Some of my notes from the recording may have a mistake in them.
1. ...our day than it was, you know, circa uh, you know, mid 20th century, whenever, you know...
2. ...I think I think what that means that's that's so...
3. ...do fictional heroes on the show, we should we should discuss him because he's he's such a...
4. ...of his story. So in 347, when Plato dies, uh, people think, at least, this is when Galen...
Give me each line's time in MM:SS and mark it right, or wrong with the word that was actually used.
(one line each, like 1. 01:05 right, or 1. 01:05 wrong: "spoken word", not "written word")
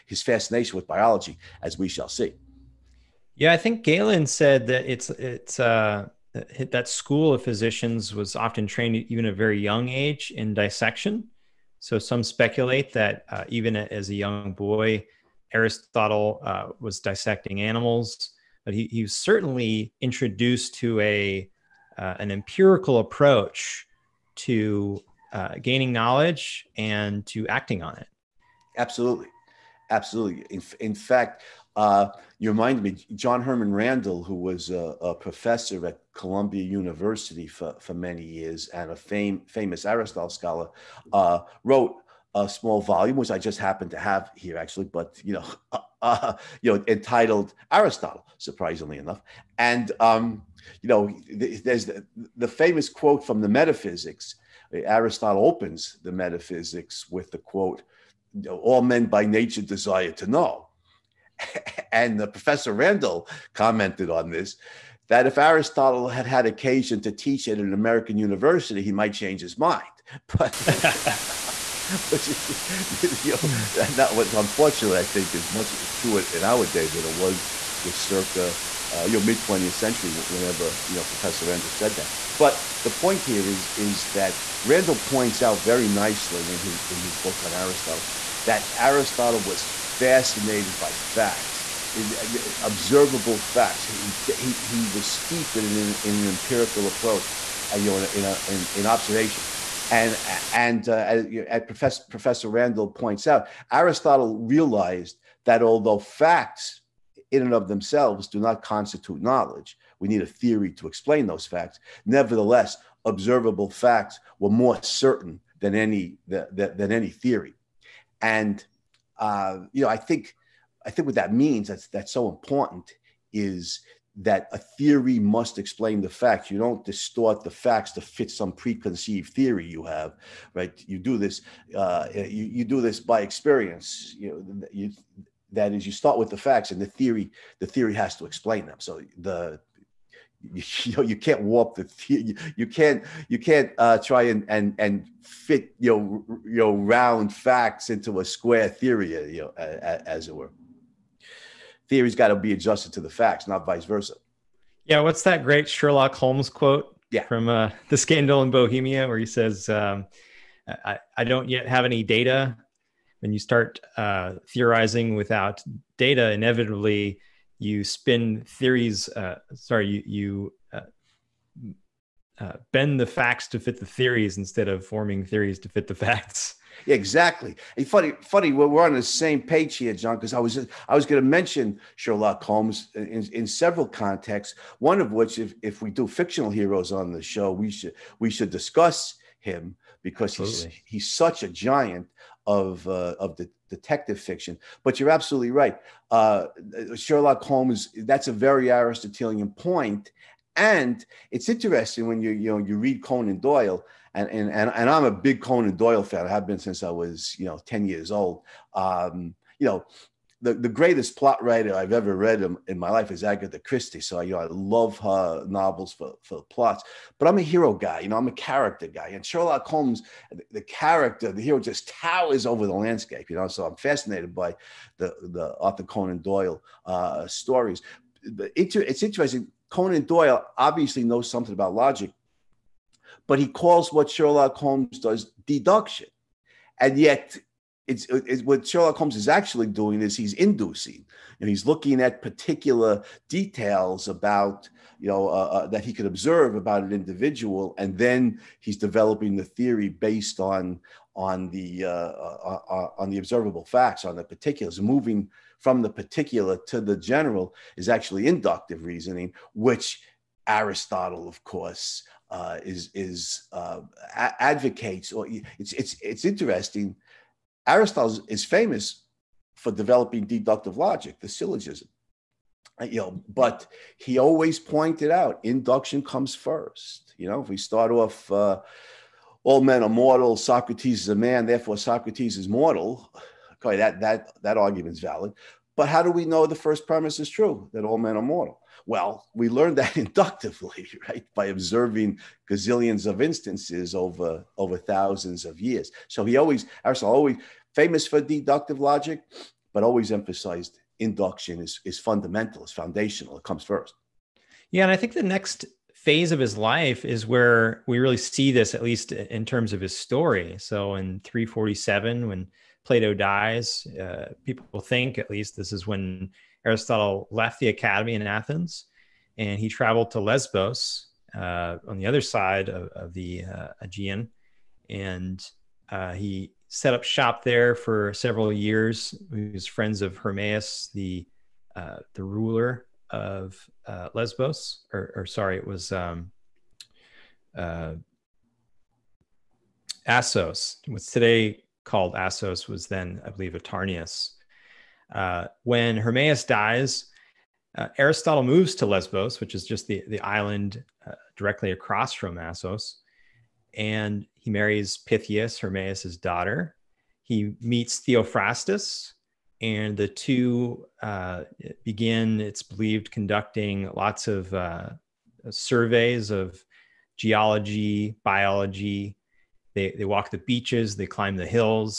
1. 01:16 right
2. 01:59 right
3. 03:05 right
4. 05:09 wrong: "Aristotle", not "Galen".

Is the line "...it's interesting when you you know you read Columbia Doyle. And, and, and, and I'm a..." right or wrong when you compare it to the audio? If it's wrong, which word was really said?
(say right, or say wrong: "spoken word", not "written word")
wrong: "Conan", not "Columbia".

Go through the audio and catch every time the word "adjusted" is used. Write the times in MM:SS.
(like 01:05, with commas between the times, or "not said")
02:32.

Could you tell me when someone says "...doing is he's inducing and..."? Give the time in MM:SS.
03:59.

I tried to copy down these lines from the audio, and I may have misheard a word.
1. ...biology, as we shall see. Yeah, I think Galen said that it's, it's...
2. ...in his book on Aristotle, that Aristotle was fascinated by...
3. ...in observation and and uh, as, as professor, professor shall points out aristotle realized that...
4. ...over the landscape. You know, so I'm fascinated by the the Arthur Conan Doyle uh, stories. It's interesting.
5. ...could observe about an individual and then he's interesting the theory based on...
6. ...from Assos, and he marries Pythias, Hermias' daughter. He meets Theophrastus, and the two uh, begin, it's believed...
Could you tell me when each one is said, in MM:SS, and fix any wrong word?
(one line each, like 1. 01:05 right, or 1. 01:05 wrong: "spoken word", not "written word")
1. 00:00 right
2. 01:26 right
3. 01:38 wrong: "randall", not "shall"
4. 03:42 right
5. 04:05 wrong: "developing", not "interesting"
6. 05:52 right.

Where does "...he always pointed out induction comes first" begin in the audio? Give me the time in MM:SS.
04:33.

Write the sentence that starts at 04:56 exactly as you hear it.
So he always, Aristotle always famous for deductive logic, but always emphasized induction is, is fundamental, is foundational, it comes first.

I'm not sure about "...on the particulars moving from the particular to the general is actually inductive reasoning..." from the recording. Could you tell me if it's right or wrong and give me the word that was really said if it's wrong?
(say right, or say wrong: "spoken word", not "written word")
right.